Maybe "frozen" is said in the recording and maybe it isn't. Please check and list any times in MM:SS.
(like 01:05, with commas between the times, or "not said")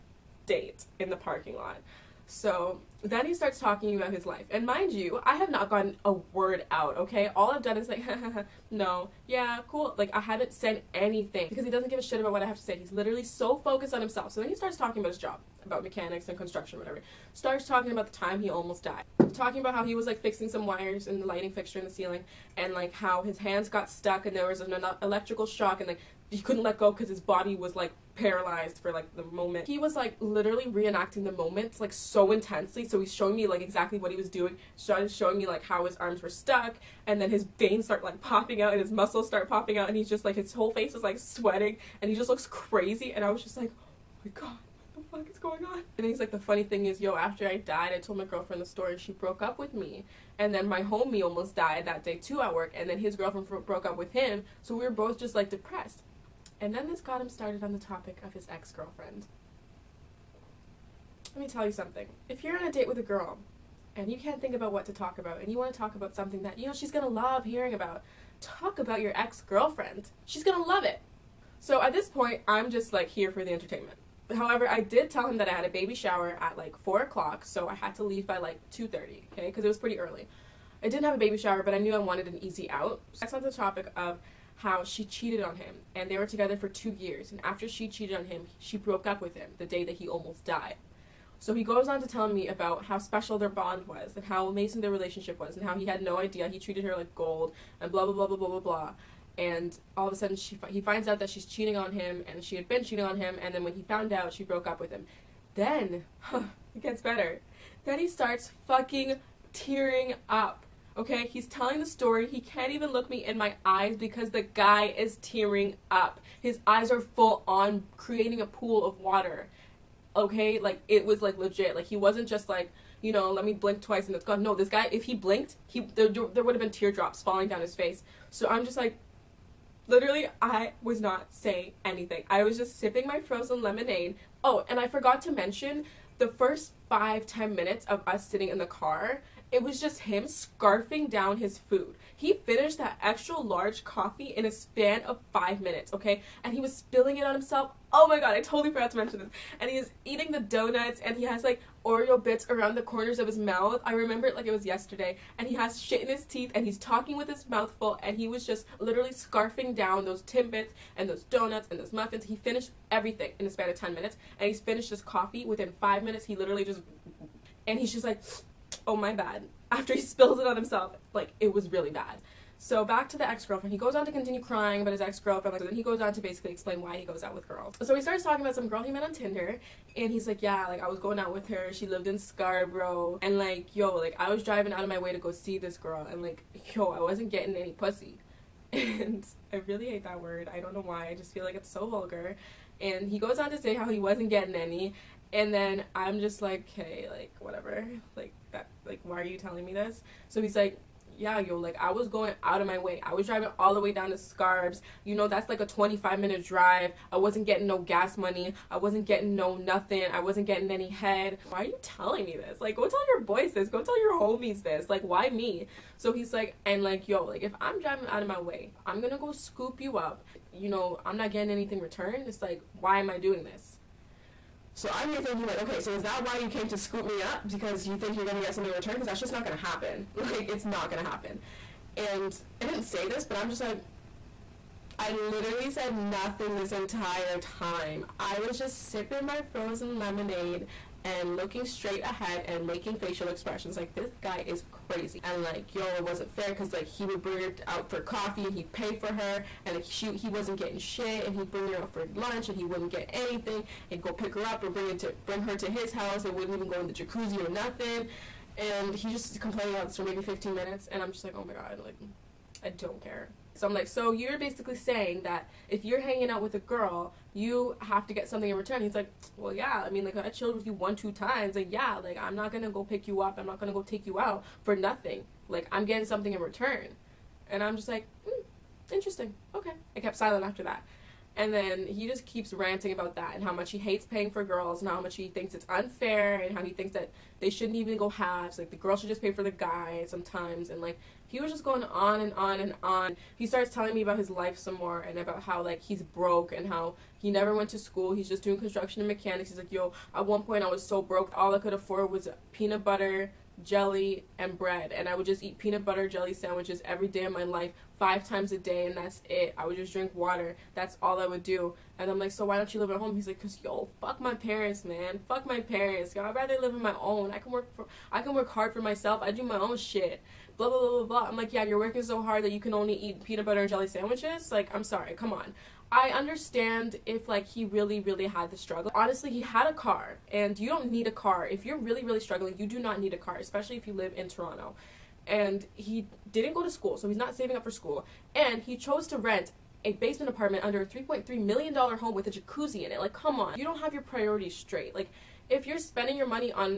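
02:13, 03:59.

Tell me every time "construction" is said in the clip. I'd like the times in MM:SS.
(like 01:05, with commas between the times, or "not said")
00:16, 04:58.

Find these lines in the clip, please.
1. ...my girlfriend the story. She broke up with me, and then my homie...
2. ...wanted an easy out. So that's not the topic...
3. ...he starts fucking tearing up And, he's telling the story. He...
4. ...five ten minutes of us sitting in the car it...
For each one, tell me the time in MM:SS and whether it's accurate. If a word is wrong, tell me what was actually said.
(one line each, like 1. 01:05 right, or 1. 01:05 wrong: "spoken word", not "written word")
1. 00:48 right
2. 01:21 right
3. 01:47 wrong: "Okay", not "And"
4. 02:16 right.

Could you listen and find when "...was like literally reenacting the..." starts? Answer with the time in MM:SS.
00:29.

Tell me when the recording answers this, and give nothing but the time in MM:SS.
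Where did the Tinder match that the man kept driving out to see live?
03:02.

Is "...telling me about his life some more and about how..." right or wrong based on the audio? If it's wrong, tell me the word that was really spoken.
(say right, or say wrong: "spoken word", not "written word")
right.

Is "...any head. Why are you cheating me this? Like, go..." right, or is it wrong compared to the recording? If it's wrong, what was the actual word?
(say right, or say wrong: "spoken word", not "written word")
wrong: "telling", not "cheating".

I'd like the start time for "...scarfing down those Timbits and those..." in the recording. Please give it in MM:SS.
02:39.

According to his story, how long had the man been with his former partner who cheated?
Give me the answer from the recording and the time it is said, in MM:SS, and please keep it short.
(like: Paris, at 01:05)
2 years, at 01:26.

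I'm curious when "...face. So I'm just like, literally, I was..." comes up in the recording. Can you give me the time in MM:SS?
02:07.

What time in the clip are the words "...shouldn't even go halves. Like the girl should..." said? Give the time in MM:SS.
04:47.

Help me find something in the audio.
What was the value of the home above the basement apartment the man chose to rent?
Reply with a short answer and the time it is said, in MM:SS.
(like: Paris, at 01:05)
$3.3 million, at 05:40.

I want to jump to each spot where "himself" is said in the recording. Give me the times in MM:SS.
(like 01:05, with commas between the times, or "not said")
00:14, 02:27, 02:50.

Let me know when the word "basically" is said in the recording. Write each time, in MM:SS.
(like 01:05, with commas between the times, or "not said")
02:56, 04:24.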